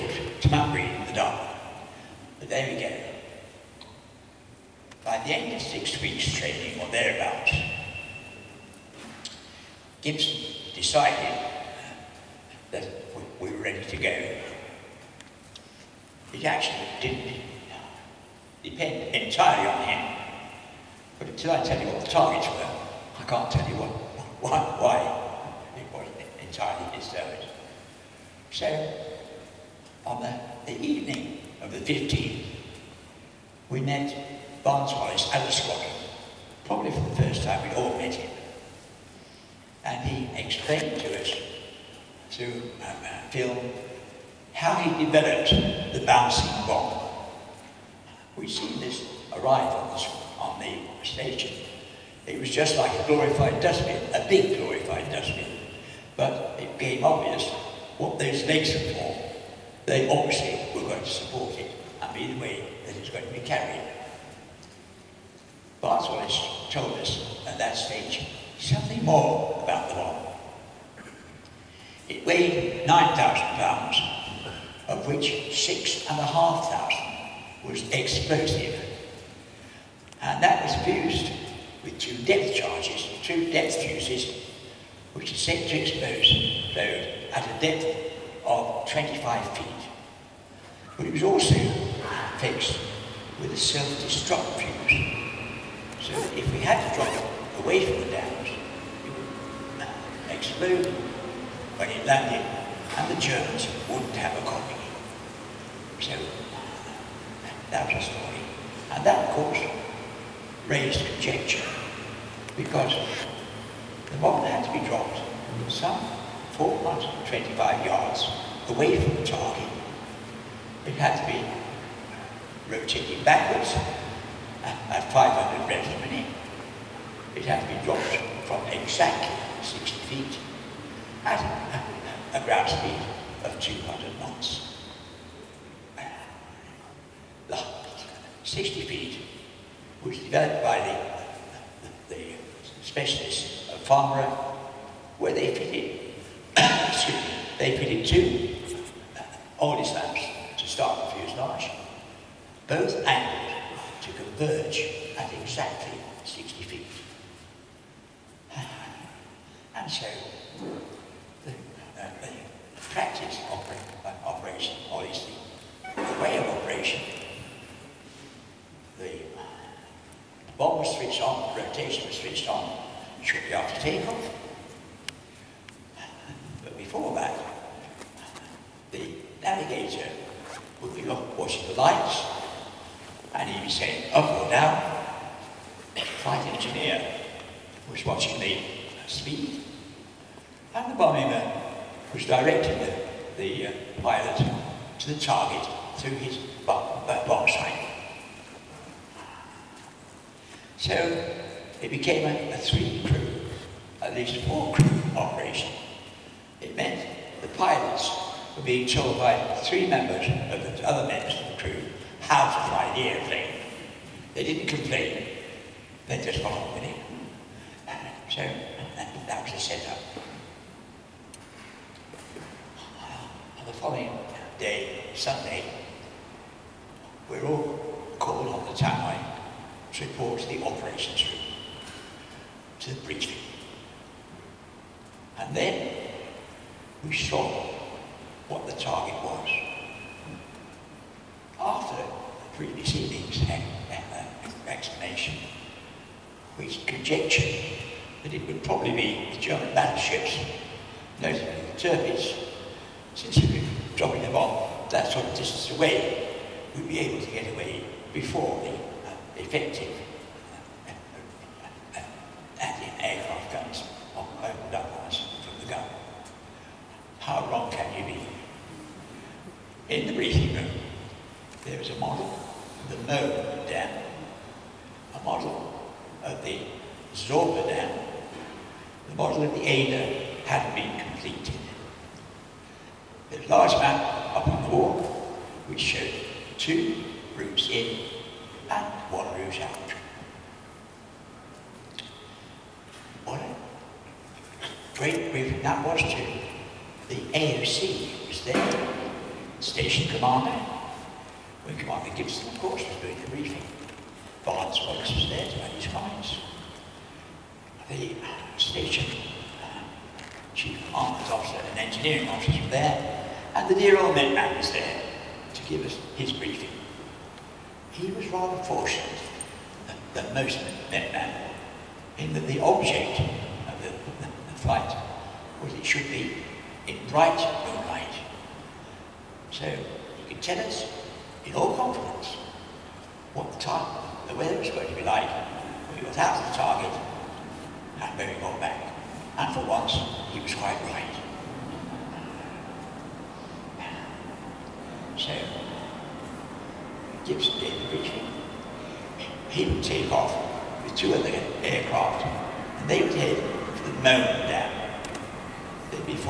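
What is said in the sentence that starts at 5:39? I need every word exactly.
And for once, he was quite right.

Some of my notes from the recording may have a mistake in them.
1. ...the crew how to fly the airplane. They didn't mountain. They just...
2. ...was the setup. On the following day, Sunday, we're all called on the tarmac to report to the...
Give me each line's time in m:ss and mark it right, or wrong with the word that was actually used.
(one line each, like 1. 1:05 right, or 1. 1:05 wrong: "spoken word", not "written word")
1. 3:31 wrong: "complain", not "mountain"
2. 3:39 right.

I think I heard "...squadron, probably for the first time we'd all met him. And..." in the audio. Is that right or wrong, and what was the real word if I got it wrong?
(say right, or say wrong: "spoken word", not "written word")
right.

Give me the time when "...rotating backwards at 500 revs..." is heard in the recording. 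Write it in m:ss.
2:02.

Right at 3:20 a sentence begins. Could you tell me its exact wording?
So it became a, a three-crew, at least four-crew operation.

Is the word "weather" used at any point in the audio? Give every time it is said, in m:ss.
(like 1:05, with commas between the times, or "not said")
5:34.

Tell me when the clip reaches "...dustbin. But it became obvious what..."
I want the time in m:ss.
0:55.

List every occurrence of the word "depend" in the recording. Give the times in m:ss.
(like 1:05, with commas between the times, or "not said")
0:18.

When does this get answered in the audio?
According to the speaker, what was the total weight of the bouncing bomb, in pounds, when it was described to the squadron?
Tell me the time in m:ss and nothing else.
1:12.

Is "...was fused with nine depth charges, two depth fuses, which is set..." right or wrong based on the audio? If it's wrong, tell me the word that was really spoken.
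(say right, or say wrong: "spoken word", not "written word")
wrong: "two", not "nine".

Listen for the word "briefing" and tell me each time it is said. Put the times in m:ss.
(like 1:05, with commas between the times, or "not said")
4:30, 4:55, 5:03, 5:16, 5:47.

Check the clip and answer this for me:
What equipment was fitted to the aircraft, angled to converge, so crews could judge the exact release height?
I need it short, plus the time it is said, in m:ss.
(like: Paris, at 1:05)
Two Aldis lamps, at 2:28.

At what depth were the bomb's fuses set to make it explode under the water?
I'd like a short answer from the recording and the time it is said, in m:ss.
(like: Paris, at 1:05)
25 feet, at 1:28.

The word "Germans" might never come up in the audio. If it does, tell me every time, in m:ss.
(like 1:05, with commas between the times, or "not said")
1:43, 4:09.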